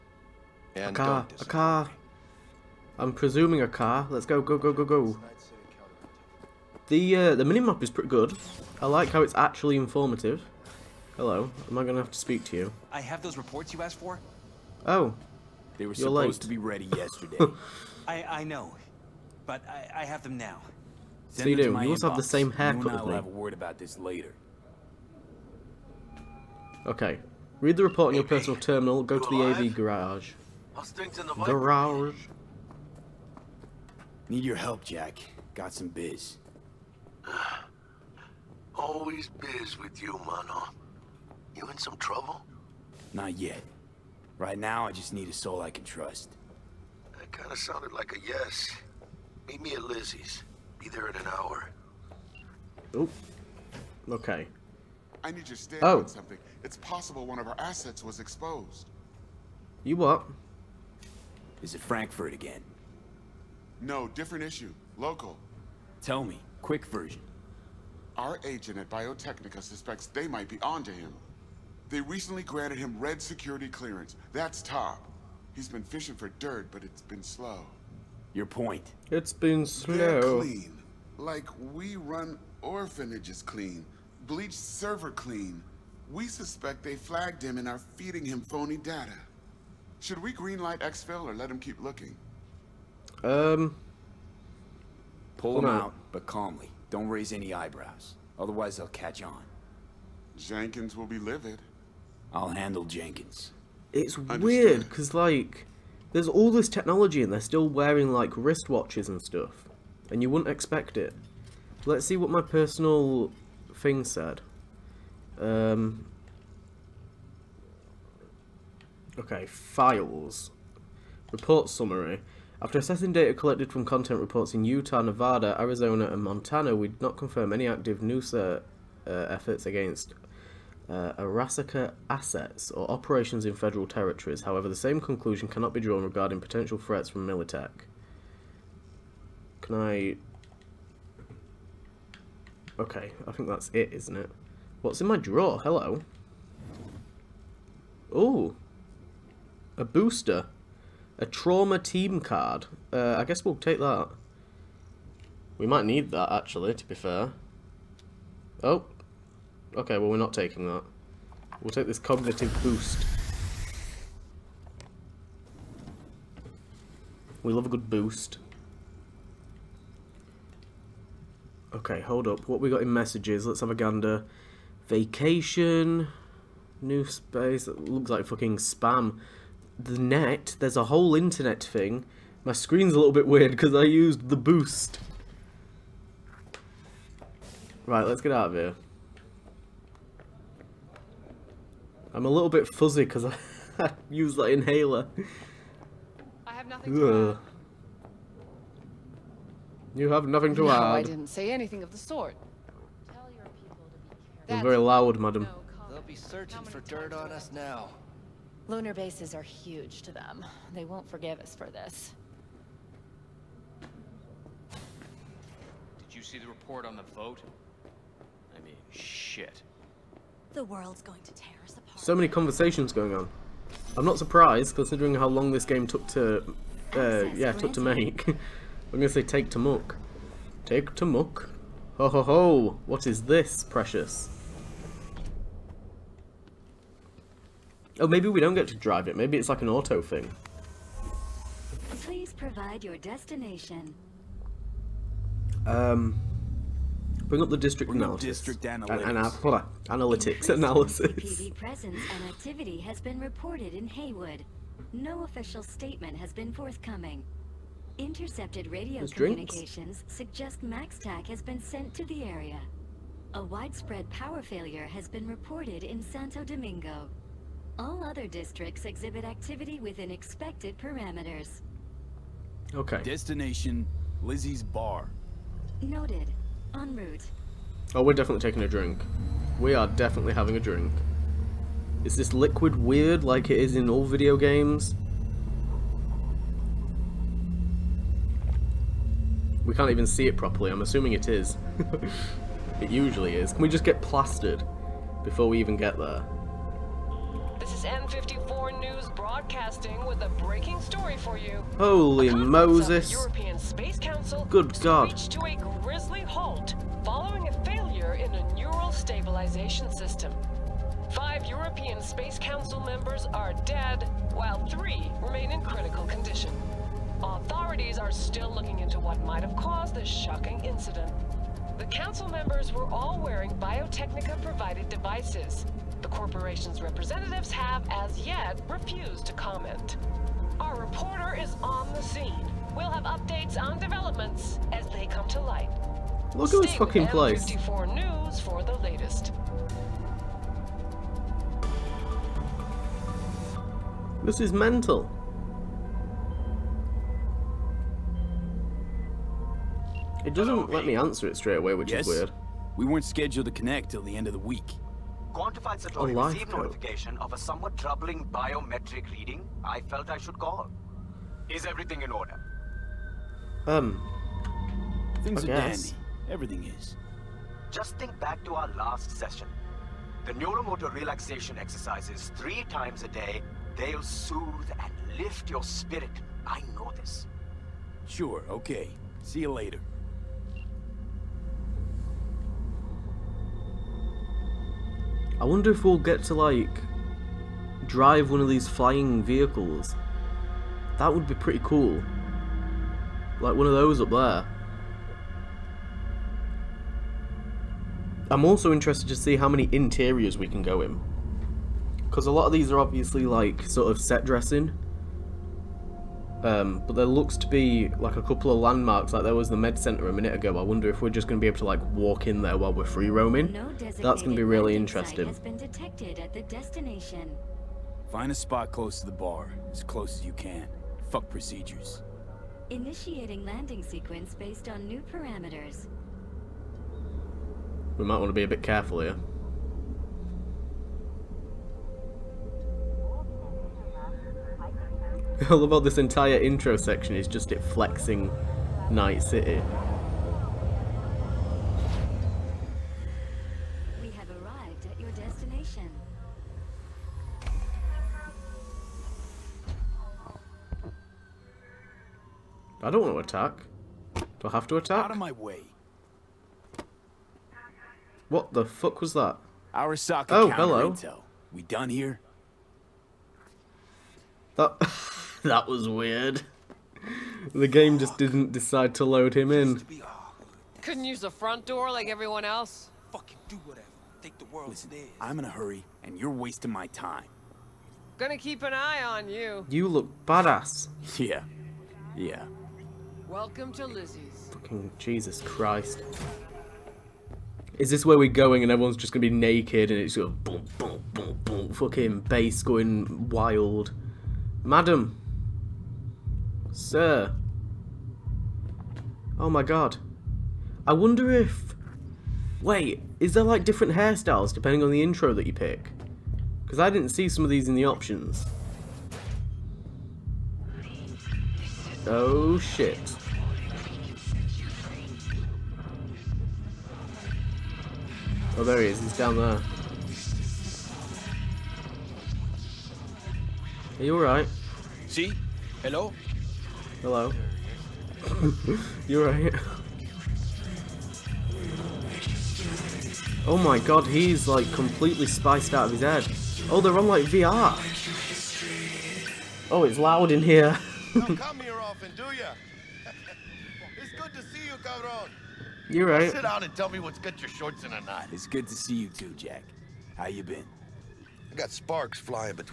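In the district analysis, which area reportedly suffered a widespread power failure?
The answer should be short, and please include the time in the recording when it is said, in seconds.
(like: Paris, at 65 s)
Santo Domingo, at 266 s.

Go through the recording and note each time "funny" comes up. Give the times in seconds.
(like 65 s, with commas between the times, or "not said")
not said.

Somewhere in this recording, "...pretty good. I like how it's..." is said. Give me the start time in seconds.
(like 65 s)
7 s.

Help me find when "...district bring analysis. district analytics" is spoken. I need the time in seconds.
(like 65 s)
247 s.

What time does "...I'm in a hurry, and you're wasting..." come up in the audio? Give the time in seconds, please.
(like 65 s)
475 s.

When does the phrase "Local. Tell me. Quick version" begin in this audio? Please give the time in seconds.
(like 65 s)
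64 s.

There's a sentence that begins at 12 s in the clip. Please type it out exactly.
I have those reports you asked for.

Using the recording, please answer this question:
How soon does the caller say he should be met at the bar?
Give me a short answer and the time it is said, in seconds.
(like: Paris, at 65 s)
An hour, at 50 s.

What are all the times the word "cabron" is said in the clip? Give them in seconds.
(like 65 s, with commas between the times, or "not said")
544 s.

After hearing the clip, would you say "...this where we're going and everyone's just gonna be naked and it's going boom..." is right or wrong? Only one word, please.
right.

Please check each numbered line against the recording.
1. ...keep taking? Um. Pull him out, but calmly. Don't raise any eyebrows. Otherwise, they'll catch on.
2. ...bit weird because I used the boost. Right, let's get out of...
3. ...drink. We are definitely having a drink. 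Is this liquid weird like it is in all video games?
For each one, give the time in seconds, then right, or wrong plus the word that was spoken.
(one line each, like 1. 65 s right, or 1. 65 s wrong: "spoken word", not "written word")
1. 91 s wrong: "looking", not "taking"
2. 183 s right
3. 278 s right.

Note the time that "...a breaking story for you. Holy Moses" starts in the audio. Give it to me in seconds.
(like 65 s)
300 s.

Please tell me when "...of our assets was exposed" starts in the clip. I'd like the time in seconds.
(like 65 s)
57 s.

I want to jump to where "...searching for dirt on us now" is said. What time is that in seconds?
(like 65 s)
206 s.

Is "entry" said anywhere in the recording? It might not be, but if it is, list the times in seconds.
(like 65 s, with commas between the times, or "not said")
not said.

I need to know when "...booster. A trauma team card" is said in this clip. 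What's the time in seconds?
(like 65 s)
149 s.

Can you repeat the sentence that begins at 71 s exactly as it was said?
They recently granted him red security clearance.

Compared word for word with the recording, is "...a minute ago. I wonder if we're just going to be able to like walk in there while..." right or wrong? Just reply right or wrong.
right.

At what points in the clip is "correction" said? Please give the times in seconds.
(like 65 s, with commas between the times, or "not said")
not said.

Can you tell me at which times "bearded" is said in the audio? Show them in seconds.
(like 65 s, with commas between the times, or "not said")
not said.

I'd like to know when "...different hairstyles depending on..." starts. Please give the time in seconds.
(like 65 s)
503 s.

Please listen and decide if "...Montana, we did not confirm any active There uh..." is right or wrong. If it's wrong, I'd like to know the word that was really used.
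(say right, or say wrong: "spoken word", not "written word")
wrong: "NUSA", not "There".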